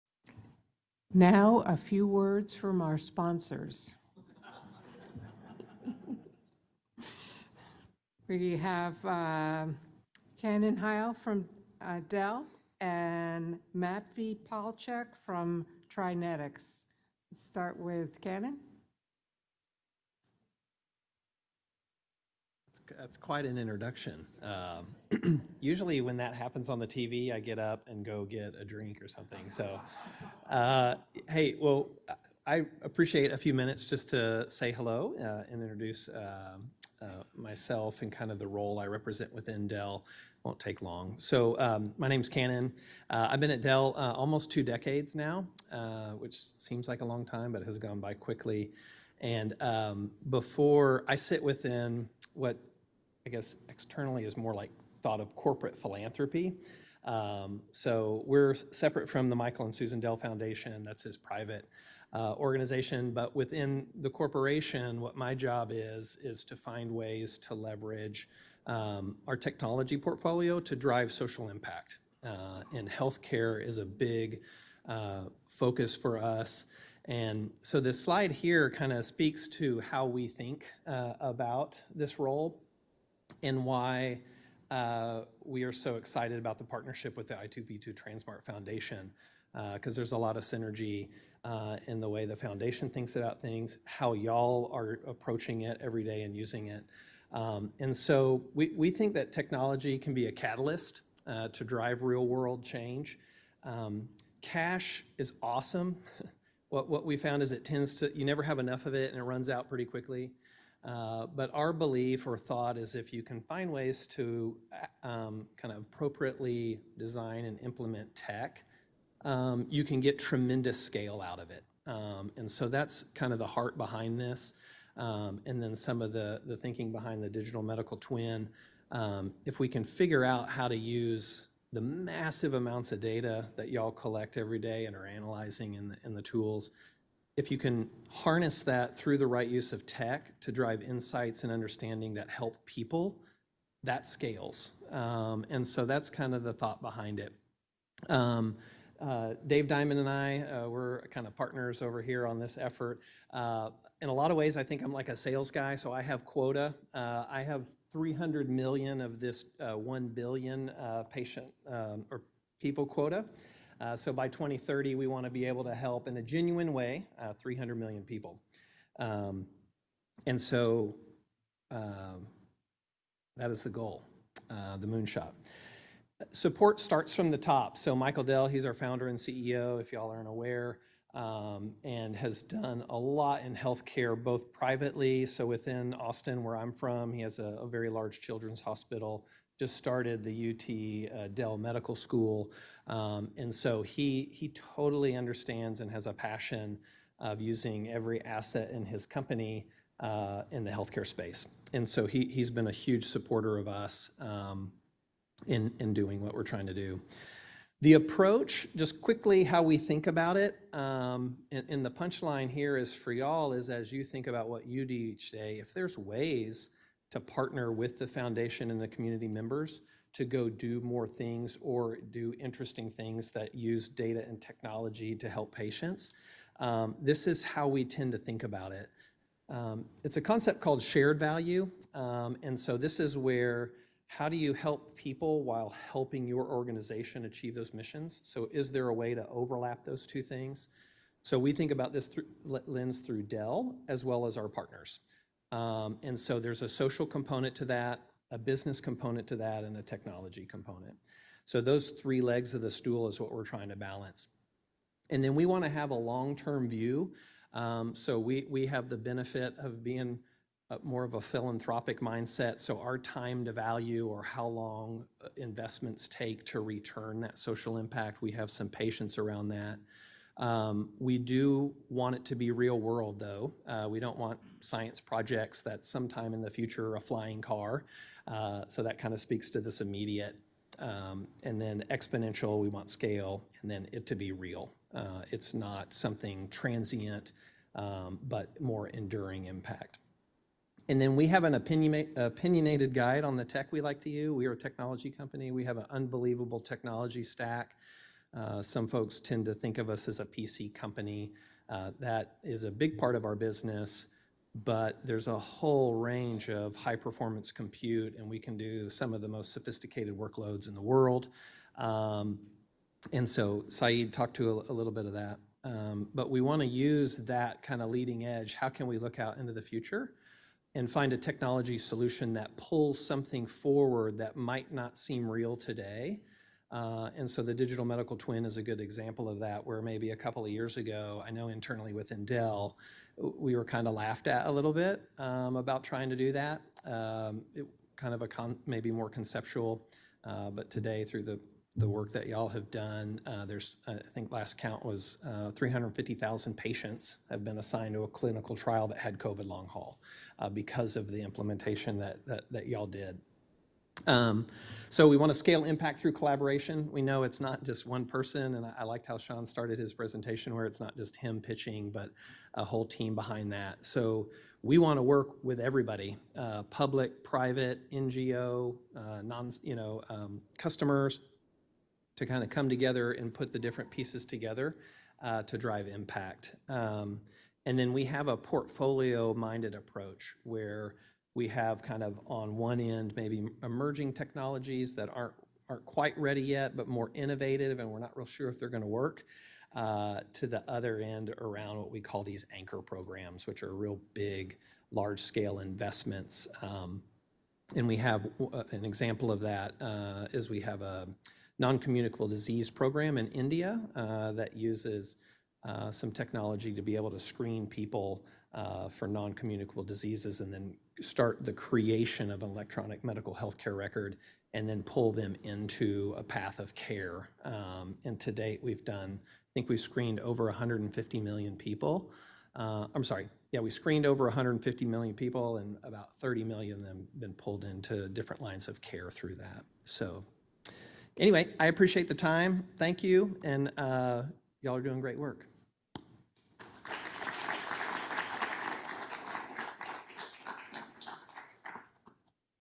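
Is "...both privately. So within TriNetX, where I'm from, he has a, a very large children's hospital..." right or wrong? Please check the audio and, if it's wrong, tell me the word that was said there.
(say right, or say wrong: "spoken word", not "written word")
wrong: "Austin", not "TriNetX".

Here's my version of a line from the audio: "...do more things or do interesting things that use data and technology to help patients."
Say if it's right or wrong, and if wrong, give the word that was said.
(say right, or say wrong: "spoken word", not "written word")
right.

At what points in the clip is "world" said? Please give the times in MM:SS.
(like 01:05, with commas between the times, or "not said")
01:42, 04:32, 05:10.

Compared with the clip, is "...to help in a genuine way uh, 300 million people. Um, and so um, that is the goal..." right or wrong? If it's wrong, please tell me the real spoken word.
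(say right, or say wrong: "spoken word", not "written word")
right.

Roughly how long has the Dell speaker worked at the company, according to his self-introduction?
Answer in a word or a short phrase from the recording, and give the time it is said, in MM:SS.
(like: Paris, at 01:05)
almost two decades, at 00:44.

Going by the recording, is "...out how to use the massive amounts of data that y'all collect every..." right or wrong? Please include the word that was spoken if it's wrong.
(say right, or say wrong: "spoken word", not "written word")
right.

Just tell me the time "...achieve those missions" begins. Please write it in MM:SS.
03:57.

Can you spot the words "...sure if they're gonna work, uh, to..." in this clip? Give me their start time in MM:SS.
06:28.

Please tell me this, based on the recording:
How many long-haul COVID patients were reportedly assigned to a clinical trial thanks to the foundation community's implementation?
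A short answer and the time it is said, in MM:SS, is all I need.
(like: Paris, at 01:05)
350,000, at 05:45.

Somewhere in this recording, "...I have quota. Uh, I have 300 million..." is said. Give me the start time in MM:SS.
02:35.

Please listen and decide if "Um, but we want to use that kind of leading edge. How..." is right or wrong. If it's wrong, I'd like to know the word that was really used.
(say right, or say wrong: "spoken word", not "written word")
right.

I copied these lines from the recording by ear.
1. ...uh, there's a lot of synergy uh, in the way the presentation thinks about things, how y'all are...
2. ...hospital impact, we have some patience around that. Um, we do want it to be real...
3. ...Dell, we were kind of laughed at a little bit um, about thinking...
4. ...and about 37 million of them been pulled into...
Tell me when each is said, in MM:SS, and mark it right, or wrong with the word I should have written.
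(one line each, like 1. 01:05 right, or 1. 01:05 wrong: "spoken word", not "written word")
1. 01:29 wrong: "foundation", not "presentation"
2. 04:27 wrong: "social", not "hospital"
3. 05:32 wrong: "trying", not "thinking"
4. 07:05 wrong: "30", not "37".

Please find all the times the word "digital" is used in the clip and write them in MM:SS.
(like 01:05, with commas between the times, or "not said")
02:07, 05:27.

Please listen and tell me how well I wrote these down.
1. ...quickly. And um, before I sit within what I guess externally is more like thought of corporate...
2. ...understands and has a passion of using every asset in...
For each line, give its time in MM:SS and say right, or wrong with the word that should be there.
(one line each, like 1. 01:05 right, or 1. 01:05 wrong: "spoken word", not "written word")
1. 00:48 right
2. 03:15 right.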